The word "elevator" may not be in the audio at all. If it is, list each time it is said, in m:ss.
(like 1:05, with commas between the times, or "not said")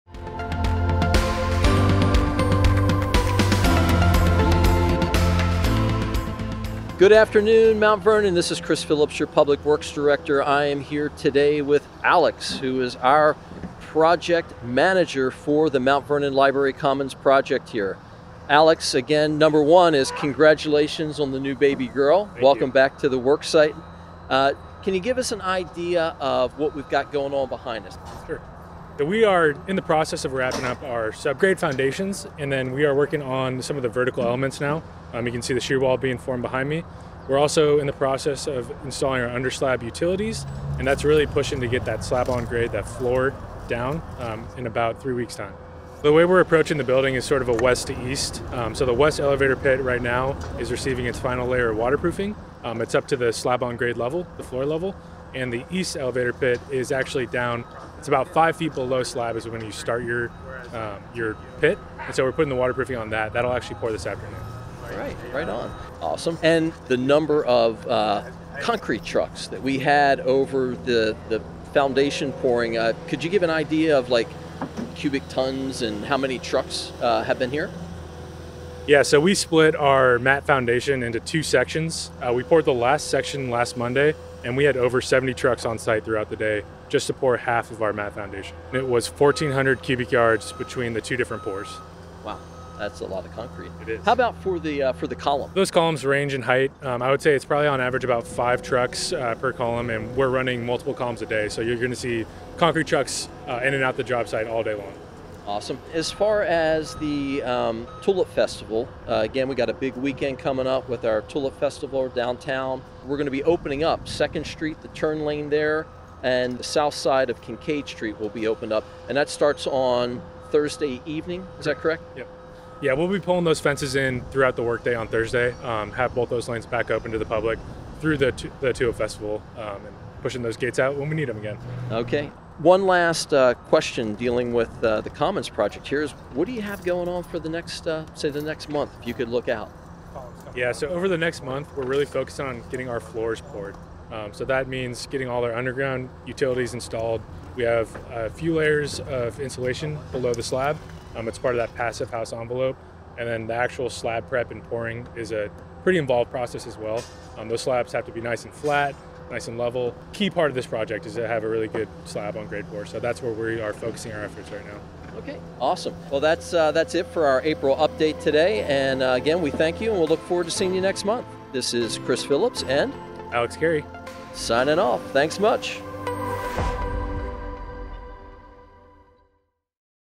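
0:49, 0:55.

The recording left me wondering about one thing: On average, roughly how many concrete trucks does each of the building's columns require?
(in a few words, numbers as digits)
5.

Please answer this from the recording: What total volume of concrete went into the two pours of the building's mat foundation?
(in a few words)
1,400 cubic yards.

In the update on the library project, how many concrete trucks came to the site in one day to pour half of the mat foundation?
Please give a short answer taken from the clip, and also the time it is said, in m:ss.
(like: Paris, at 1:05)
over 70, at 1:24.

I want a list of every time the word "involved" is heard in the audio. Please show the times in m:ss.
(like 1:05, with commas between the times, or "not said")
2:35.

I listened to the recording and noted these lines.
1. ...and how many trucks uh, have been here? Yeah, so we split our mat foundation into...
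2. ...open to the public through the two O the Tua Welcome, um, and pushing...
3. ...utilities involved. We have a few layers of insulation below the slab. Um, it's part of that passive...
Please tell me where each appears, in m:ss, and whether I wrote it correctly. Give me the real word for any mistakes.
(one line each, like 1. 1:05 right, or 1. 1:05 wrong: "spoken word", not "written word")
1. 1:15 right
2. 2:06 wrong: "Festival", not "Welcome"
3. 2:26 wrong: "installed", not "involved".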